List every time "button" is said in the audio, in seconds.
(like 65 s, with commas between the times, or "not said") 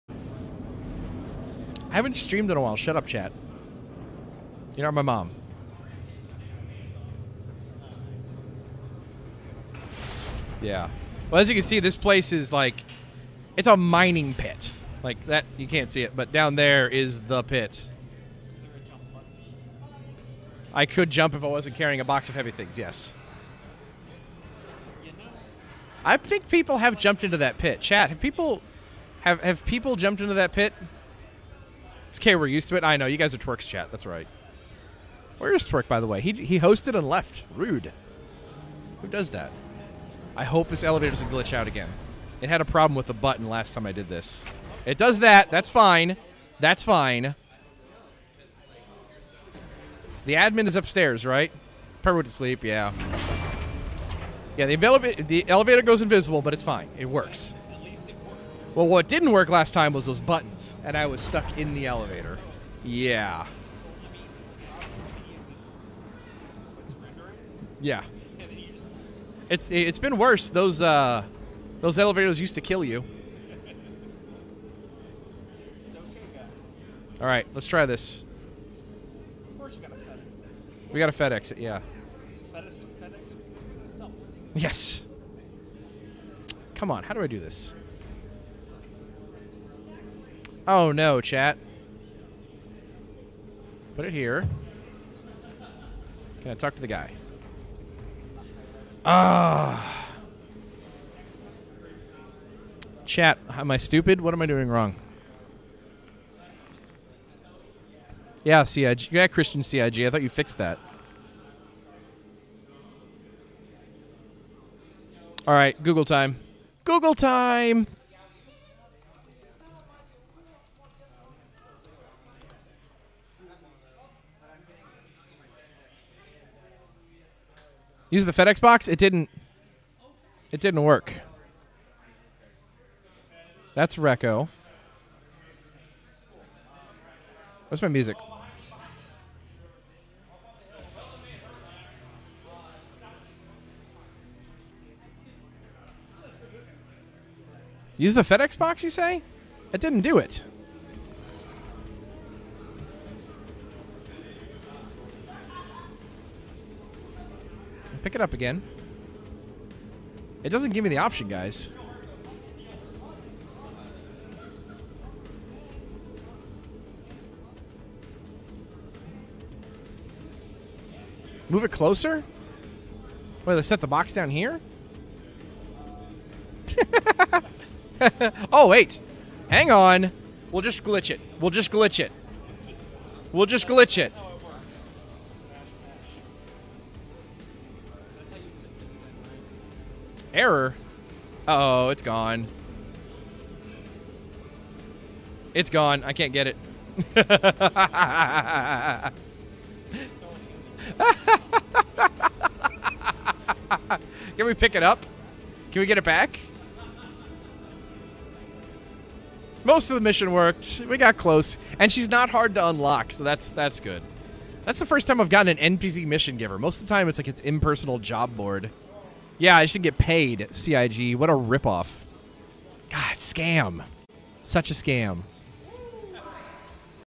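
43 s, 60 s.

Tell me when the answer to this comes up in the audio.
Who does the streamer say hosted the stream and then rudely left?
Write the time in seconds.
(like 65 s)
35 s.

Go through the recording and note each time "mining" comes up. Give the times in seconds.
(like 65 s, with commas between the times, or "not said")
13 s.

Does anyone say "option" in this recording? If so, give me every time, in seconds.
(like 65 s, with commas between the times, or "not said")
160 s.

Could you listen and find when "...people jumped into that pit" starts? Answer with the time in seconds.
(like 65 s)
29 s.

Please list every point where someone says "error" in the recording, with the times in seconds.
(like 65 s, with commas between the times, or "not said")
190 s.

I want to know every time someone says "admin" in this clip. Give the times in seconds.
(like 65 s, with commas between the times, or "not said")
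50 s.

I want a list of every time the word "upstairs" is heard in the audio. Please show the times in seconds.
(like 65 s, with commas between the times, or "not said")
50 s.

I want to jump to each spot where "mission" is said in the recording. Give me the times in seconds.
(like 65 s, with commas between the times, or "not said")
210 s, 216 s.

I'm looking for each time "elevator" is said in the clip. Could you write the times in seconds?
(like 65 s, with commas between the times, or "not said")
40 s, 55 s, 61 s, 71 s.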